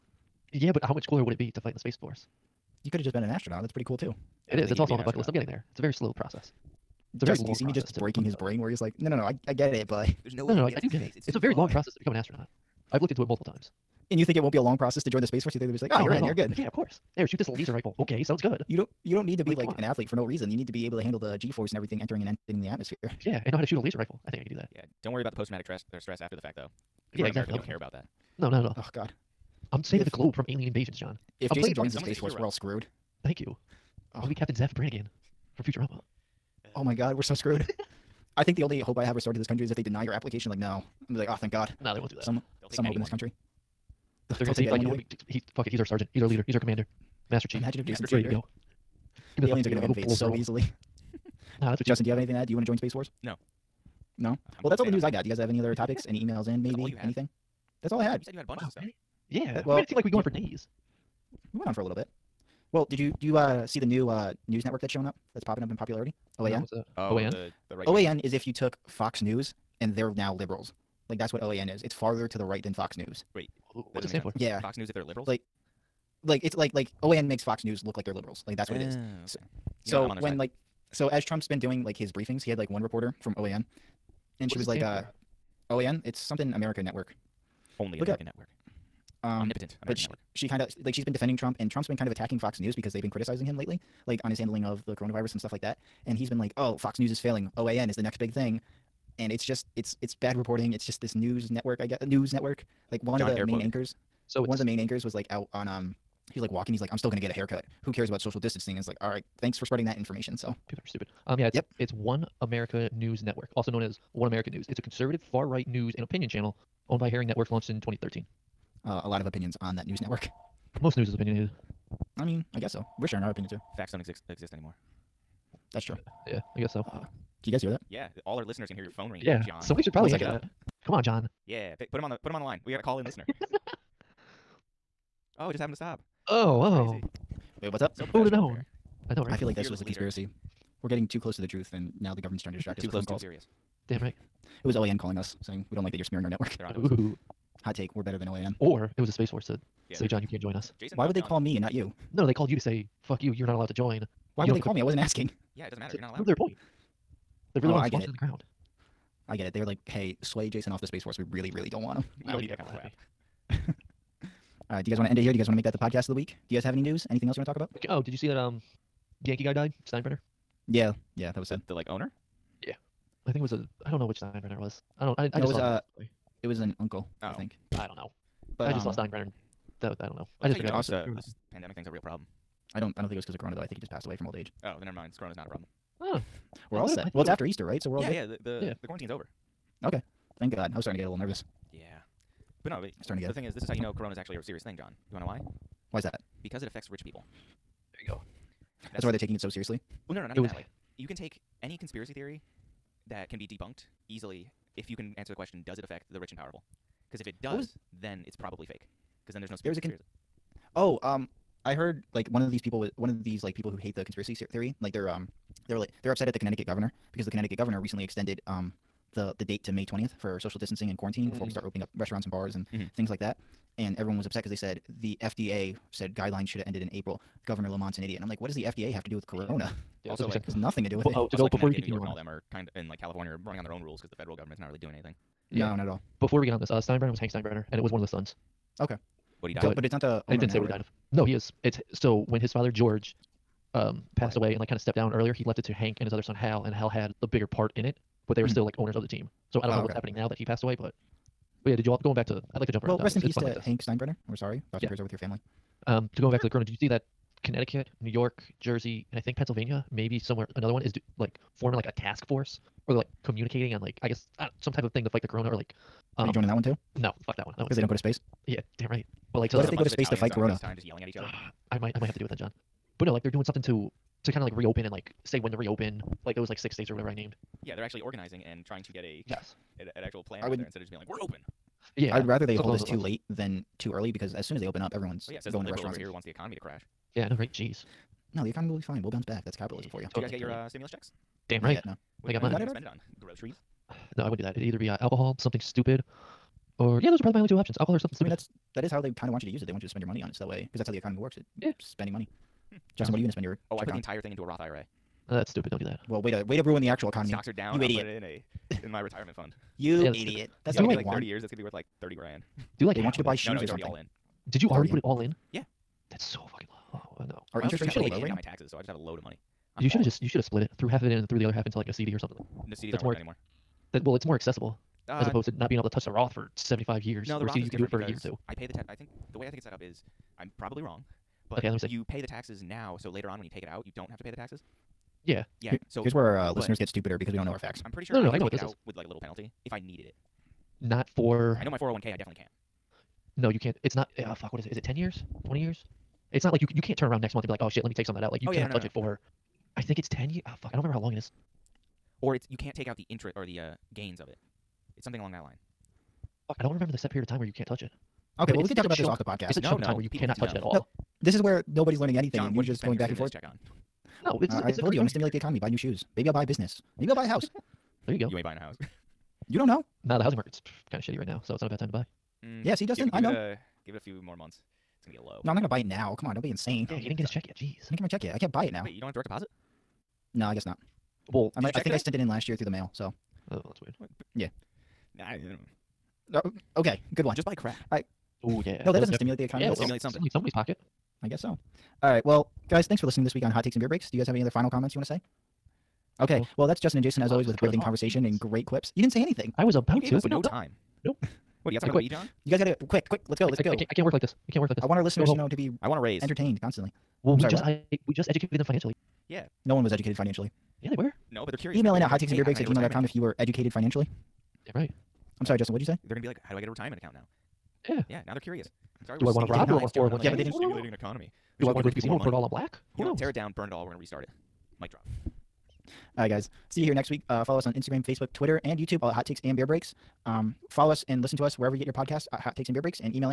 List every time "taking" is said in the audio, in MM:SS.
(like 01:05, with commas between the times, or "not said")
03:19.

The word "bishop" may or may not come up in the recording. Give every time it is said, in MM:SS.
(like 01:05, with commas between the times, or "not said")
not said.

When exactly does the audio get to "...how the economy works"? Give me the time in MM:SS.
05:00.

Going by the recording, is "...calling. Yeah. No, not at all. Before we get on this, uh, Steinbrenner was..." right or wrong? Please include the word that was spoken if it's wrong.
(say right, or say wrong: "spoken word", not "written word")
wrong: "anything", not "calling".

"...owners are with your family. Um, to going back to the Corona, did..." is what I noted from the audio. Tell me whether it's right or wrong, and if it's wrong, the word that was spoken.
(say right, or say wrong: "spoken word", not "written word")
wrong: "prayers", not "owners".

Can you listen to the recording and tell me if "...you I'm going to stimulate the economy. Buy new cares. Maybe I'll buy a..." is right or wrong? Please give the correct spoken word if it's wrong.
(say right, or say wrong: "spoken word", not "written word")
wrong: "shoes", not "cares".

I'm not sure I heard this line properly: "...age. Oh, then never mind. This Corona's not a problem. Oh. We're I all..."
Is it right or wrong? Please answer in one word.
right.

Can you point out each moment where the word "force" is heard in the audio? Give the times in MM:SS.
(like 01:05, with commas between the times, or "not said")
00:02, 00:15, 00:21, 00:32, 00:52, 02:29, 02:41, 04:22.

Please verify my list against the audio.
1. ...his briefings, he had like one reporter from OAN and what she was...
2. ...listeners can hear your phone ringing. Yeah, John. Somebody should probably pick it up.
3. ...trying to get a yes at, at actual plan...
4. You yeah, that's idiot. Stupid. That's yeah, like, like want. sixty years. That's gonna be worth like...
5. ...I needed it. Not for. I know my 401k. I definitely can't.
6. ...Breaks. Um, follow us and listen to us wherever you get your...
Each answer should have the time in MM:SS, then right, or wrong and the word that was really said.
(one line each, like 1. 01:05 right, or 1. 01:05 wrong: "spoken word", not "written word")
1. 01:21 right
2. 02:08 right
3. 04:38 right
4. 05:09 wrong: "thirty", not "sixty"
5. 05:39 right
6. 07:09 right.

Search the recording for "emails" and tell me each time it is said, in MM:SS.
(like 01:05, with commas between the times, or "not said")
00:56, 06:51.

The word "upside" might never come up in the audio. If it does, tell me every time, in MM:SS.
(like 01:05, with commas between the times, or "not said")
not said.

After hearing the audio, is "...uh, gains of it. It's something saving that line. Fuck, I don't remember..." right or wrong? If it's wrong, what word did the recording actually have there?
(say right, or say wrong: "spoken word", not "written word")
wrong: "along", not "saving".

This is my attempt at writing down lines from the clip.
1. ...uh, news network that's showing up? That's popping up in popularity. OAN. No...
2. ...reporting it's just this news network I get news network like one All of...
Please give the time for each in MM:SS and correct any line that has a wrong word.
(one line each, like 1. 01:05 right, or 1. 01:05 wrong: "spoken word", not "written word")
1. 01:04 right
2. 01:40 wrong: "John", not "All".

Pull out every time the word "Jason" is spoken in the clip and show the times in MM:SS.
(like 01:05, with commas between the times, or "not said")
00:31, 00:47, 02:30, 02:40, 06:37.